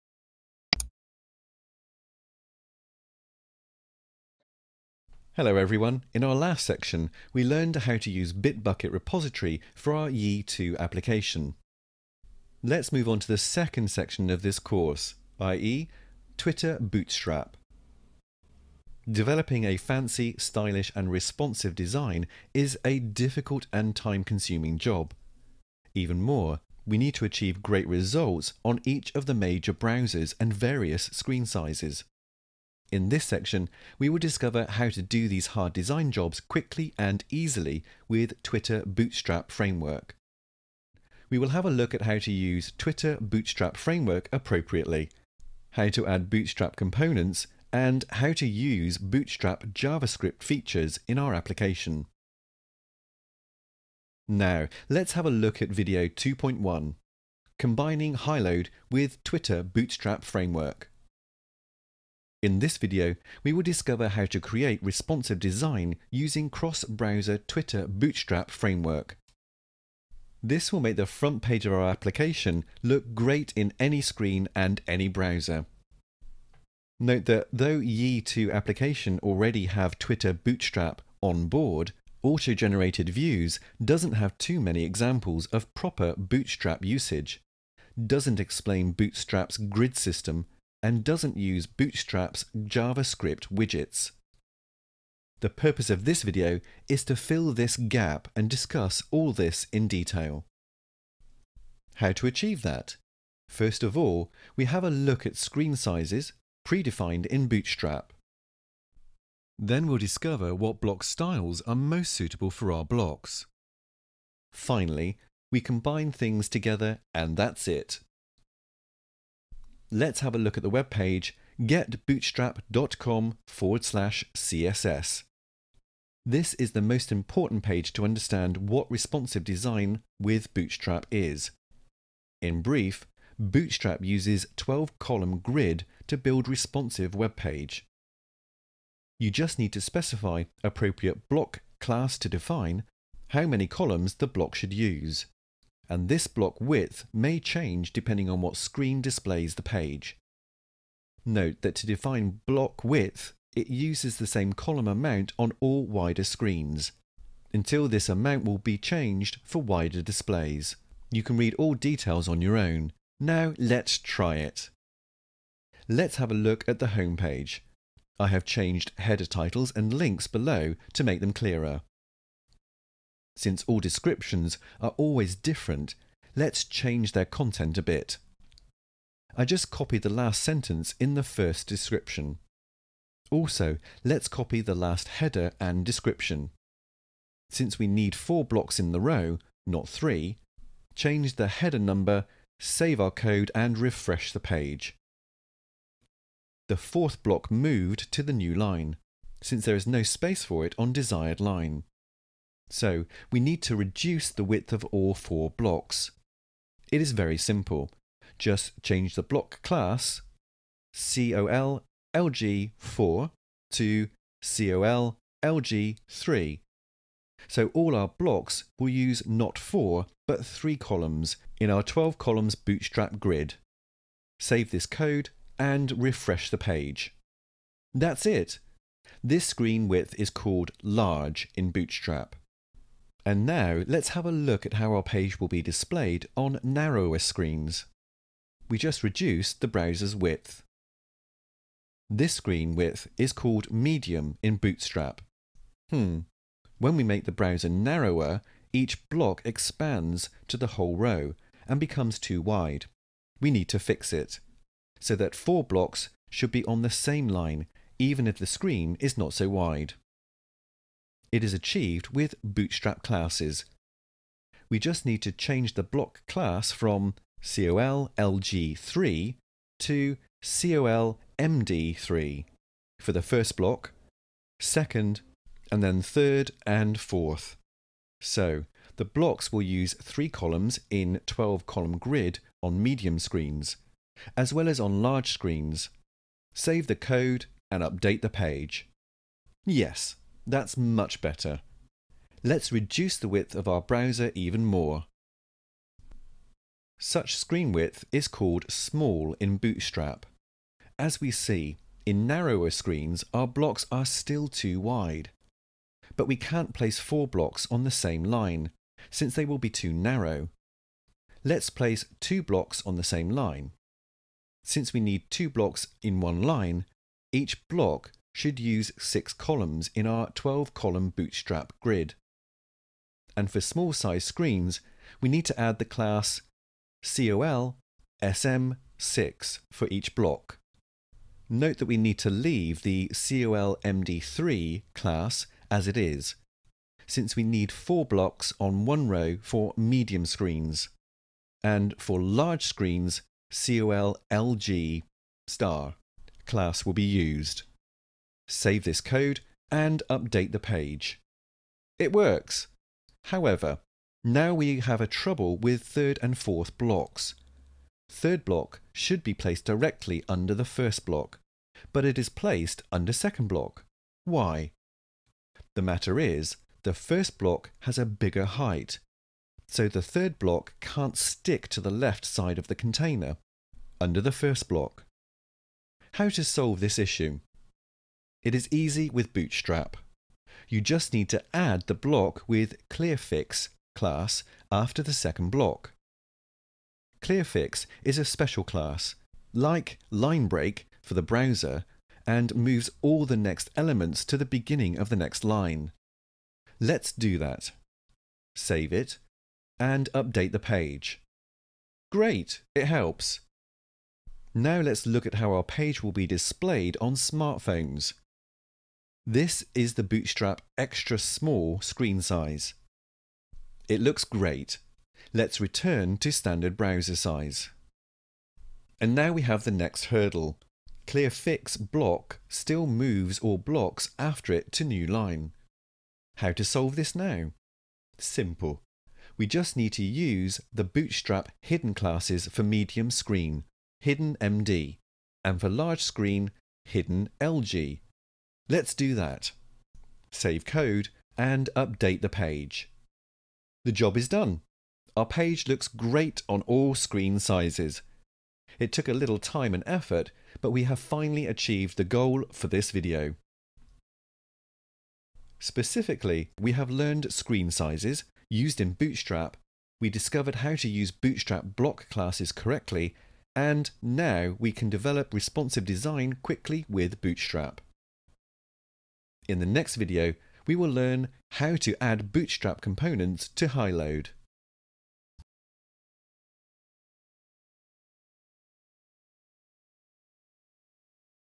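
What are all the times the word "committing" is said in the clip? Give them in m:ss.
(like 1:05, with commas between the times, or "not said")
not said.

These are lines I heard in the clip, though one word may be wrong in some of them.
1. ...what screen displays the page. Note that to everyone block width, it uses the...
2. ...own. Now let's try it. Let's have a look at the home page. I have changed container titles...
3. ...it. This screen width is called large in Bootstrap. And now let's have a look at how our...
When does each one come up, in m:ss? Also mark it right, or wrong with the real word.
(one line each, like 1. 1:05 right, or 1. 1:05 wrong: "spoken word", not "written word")
1. 2:28 wrong: "define", not "everyone"
2. 2:42 wrong: "header", not "container"
3. 3:48 right.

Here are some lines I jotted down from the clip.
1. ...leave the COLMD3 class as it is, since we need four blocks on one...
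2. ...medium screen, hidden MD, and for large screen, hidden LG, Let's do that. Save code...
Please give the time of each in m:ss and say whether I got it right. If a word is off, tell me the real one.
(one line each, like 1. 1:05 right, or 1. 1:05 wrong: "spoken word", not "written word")
1. 5:32 right
2. 7:12 right.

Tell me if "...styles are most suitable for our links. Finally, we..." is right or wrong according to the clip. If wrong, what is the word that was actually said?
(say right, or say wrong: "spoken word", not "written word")
wrong: "blocks", not "links".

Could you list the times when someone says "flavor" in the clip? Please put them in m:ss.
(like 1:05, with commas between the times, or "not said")
not said.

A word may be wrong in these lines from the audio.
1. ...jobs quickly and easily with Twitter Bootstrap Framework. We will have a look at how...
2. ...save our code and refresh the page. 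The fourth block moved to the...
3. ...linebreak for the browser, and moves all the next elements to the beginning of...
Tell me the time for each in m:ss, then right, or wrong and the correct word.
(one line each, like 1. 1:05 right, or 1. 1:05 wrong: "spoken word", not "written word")
1. 0:36 right
2. 3:12 right
3. 6:30 right.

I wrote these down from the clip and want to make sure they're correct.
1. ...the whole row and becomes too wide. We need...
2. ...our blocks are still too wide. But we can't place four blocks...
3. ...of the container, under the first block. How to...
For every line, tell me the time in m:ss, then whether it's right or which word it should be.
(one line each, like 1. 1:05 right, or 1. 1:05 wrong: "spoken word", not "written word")
1. 4:10 right
2. 5:03 right
3. 6:12 right.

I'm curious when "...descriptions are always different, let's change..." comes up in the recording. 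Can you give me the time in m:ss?
2:53.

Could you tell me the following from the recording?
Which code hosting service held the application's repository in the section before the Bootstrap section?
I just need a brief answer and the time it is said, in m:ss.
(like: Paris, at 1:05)
Bitbucket, at 0:08.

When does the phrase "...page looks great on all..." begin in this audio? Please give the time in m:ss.
7:25.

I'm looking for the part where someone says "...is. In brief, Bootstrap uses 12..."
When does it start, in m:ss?
2:11.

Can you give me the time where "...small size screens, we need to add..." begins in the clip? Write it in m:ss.
5:23.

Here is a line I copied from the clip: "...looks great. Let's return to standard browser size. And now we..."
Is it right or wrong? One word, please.
right.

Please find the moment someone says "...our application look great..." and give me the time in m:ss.
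1:11.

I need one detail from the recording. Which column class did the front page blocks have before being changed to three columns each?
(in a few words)
col-lg-4.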